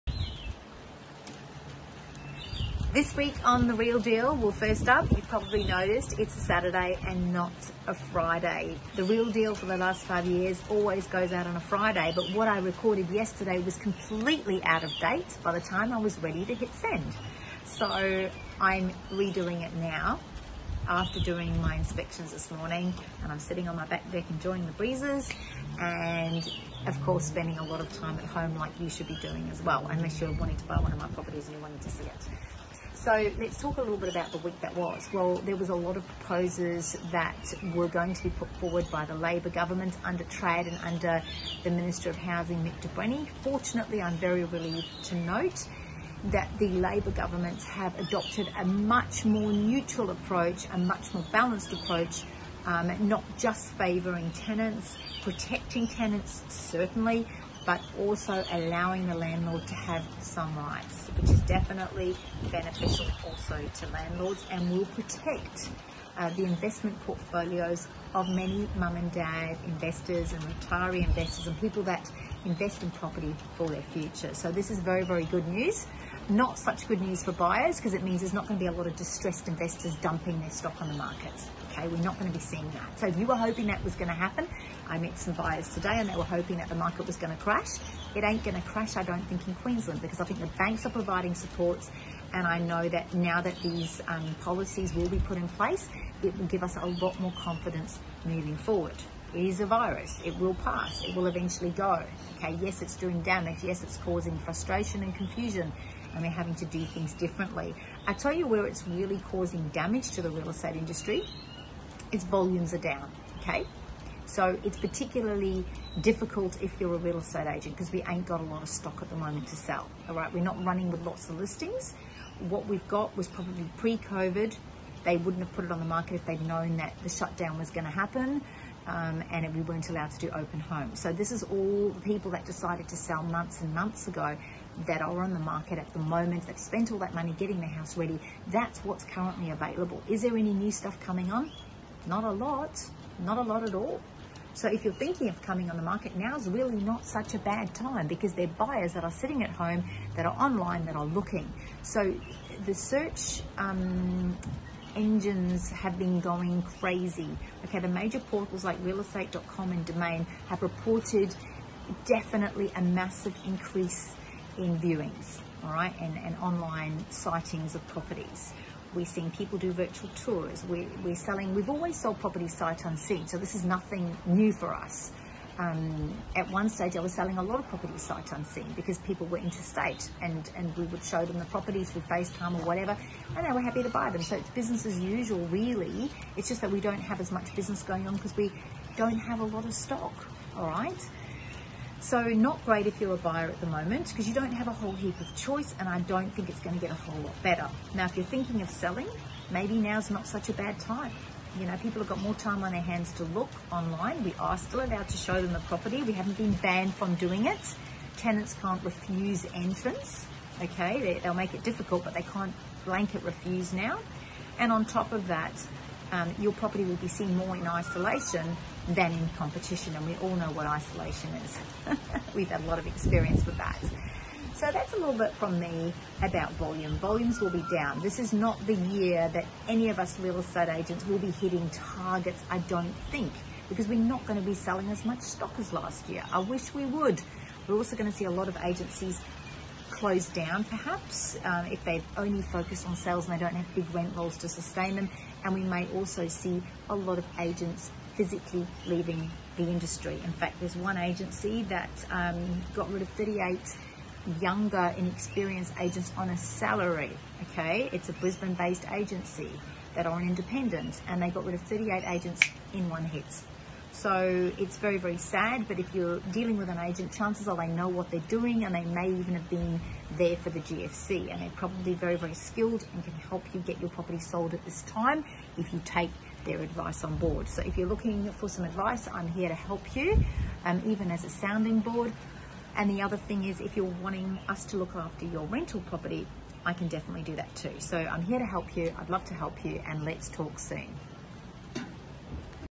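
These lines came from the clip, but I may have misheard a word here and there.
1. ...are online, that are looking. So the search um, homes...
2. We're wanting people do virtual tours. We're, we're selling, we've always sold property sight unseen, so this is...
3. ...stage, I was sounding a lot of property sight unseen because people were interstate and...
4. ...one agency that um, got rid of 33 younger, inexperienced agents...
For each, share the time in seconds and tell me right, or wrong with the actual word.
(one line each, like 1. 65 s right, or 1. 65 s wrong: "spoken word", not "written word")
1. 150 s wrong: "engines", not "homes"
2. 168 s wrong: "seeing", not "wanting"
3. 176 s wrong: "selling", not "sounding"
4. 250 s wrong: "38", not "33".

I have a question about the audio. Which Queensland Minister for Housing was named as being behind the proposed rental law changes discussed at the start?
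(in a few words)
Mick de Brenni.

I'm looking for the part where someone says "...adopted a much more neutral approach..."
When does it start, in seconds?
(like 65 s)
47 s.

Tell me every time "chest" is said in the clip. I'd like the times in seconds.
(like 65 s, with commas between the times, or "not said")
not said.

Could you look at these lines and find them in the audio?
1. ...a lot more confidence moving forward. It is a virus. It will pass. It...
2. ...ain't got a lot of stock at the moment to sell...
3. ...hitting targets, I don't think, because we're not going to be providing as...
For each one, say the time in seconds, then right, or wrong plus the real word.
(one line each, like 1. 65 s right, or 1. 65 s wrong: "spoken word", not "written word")
1. 96 s right
2. 118 s right
3. 231 s wrong: "selling", not "providing".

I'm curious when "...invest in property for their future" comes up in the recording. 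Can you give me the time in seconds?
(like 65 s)
72 s.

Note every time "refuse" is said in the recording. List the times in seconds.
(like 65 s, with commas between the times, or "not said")
208 s, 213 s.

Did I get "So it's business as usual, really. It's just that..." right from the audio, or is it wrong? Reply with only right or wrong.
right.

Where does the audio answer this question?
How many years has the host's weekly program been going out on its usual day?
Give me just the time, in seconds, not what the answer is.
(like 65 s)
10 s.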